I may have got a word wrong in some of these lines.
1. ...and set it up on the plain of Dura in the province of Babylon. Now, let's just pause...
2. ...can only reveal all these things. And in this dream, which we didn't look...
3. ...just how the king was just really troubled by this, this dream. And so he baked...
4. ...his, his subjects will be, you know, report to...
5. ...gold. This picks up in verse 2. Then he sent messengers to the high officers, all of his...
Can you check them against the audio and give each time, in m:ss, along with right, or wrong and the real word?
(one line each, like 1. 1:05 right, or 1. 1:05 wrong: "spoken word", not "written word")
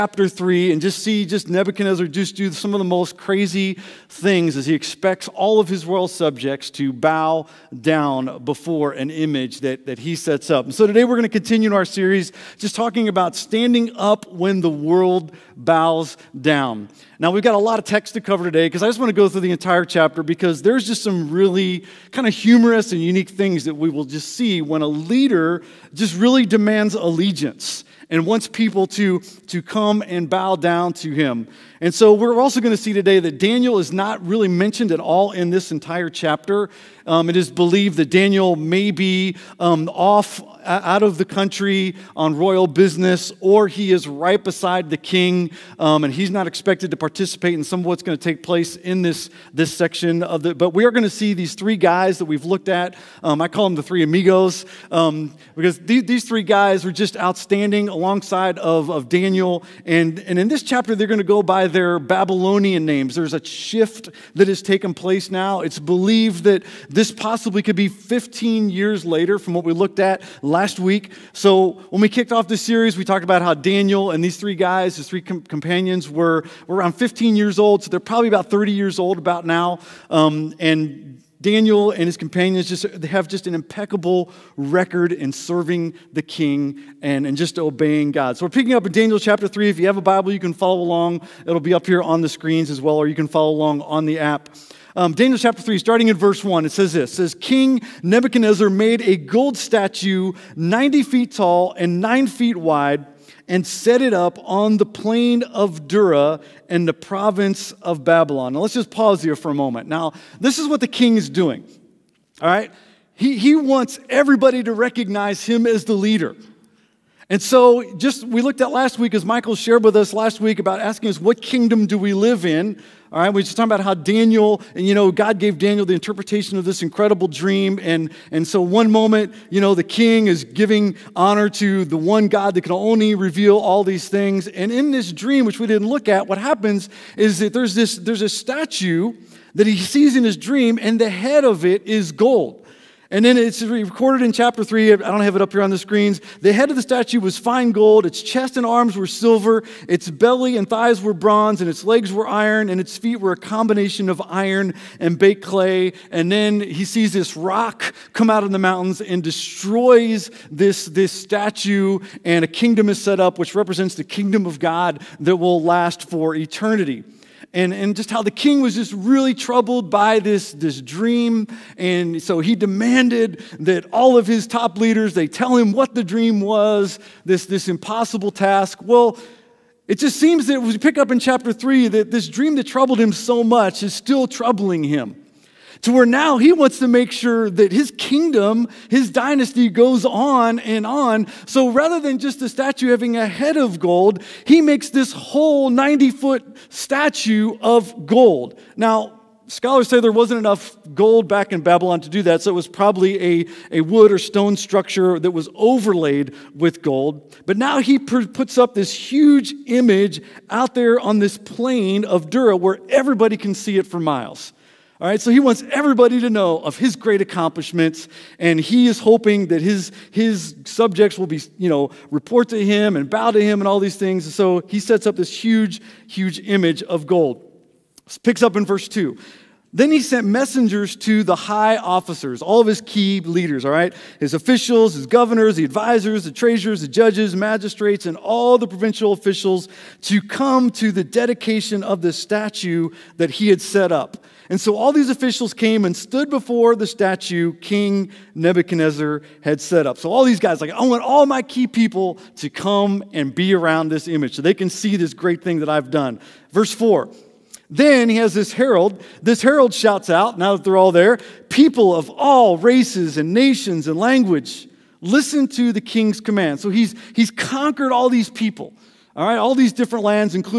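1. 1:43 right
2. 2:12 right
3. 2:47 wrong: "demanded", not "baked"
4. 3:39 right
5. 3:47 right.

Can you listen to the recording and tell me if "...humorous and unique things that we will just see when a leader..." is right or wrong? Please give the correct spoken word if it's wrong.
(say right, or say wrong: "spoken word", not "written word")
right.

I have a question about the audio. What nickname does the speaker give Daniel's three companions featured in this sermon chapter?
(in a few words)
the three amigos.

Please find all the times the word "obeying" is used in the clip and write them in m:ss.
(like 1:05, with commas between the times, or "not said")
1:27.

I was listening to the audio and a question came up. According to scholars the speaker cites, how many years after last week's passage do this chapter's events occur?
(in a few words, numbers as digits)
15 years.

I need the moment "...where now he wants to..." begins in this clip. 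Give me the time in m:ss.
3:05.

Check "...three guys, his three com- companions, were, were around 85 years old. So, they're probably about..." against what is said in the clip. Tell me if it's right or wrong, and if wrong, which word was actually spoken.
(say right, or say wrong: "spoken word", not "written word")
wrong: "15", not "85".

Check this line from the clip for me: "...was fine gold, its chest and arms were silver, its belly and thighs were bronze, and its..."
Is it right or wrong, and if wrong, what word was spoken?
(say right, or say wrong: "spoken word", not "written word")
right.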